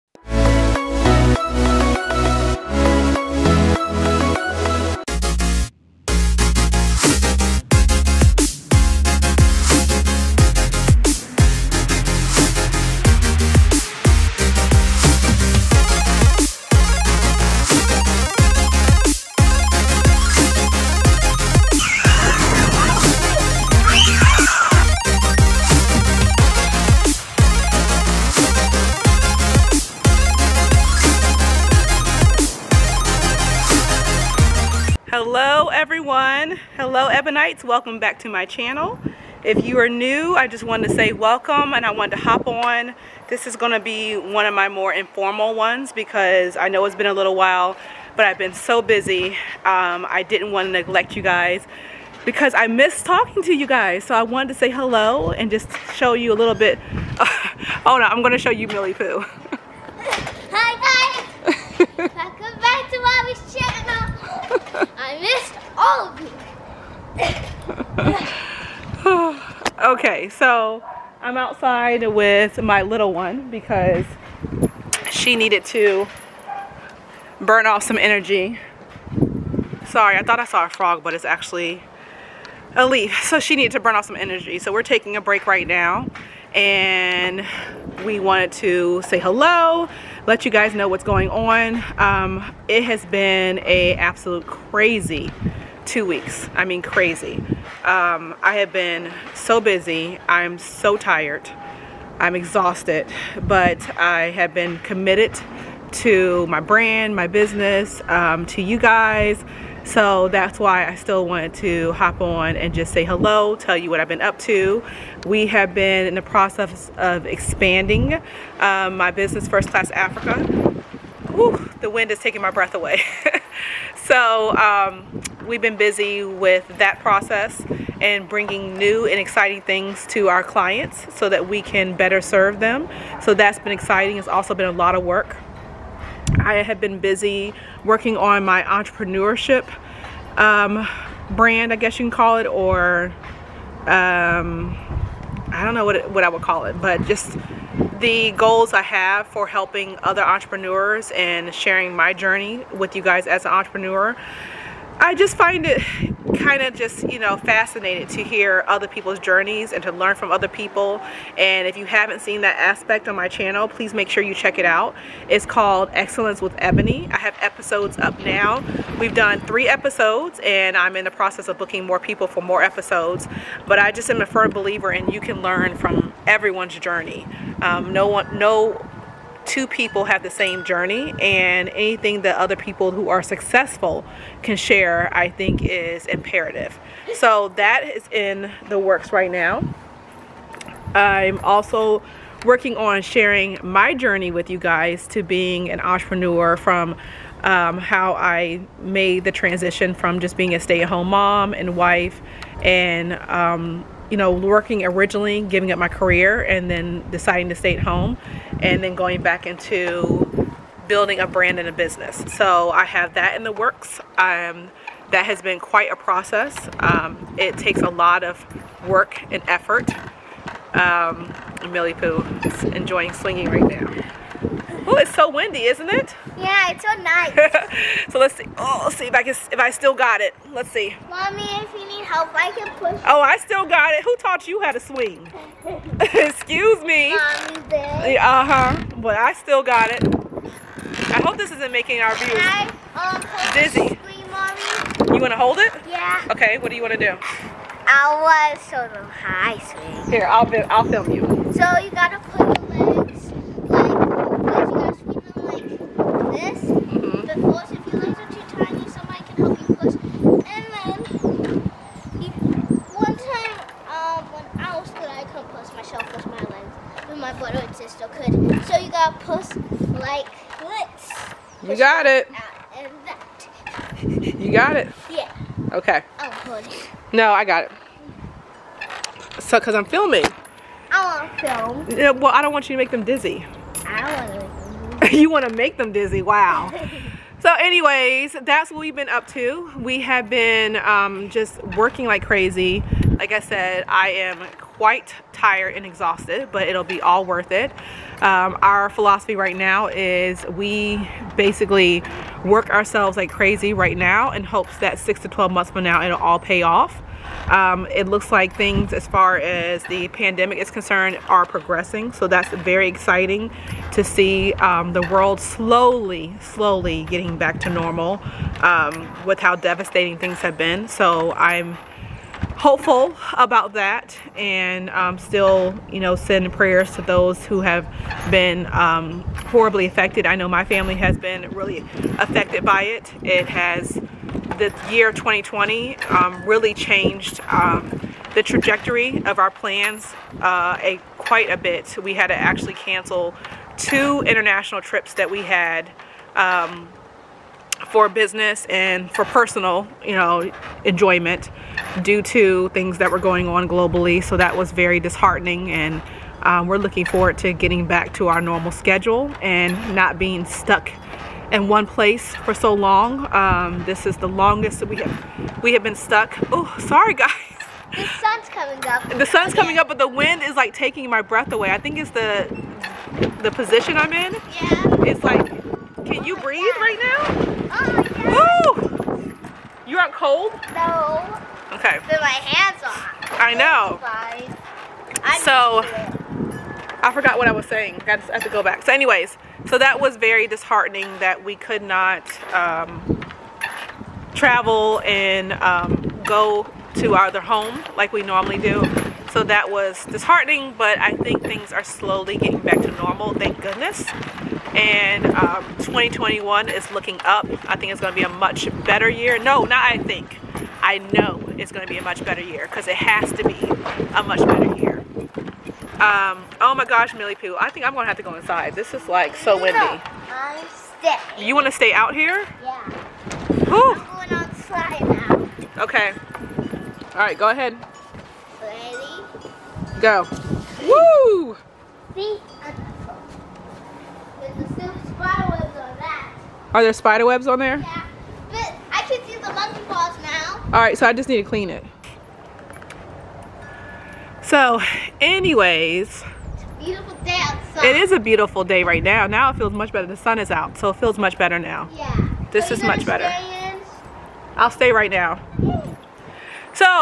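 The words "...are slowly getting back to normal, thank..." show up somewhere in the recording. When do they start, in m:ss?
6:41.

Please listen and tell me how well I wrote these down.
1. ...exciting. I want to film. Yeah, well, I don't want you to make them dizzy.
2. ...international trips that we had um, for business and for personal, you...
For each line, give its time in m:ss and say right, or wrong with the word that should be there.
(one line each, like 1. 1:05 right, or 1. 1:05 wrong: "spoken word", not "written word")
1. 4:39 wrong: "filming", not "exciting"
2. 5:44 right.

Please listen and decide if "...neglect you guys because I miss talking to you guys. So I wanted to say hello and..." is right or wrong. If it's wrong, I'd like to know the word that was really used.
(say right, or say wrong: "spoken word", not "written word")
right.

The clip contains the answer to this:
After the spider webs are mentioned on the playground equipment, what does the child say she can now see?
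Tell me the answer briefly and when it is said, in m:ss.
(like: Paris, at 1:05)
monkey paws, at 7:19.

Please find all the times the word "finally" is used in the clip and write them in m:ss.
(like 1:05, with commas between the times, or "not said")
not said.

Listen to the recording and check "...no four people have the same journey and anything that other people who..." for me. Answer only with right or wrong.
wrong.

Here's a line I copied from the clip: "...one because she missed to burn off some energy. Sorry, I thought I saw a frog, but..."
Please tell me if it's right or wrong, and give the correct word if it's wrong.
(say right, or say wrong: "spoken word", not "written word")
wrong: "needed", not "missed".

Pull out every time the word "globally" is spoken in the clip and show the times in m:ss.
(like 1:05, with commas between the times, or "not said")
5:53.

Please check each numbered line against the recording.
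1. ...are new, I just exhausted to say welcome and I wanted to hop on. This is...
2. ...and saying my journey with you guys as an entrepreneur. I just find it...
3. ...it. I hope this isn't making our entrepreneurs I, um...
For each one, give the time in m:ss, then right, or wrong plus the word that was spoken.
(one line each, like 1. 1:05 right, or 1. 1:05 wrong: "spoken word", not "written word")
1. 0:39 wrong: "wanted", not "exhausted"
2. 2:31 wrong: "sharing", not "saying"
3. 3:59 wrong: "viewers", not "entrepreneurs".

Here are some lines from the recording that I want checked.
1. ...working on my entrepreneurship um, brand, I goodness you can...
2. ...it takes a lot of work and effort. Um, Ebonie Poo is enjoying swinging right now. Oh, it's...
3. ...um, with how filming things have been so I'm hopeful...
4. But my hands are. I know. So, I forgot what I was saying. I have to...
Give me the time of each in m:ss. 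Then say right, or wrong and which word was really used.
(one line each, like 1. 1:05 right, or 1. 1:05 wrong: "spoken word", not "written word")
1. 2:17 wrong: "guess", not "goodness"
2. 3:37 wrong: "Millie", not "Ebonie"
3. 5:18 wrong: "devastating", not "filming"
4. 6:22 right.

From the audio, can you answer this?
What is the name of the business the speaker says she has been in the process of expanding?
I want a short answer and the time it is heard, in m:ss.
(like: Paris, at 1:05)
First Class Africa, at 1:59.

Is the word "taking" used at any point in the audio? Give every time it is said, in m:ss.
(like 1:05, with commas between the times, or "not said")
1:24, 2:02, 6:10.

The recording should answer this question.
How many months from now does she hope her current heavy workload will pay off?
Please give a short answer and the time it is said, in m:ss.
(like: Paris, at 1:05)
6 to 12 months, at 5:04.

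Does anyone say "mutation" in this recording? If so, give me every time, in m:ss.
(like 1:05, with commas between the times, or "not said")
not said.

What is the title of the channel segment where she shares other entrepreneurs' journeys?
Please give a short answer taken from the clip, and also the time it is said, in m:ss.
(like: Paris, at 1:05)
Excellence with Ebonie, at 2:45.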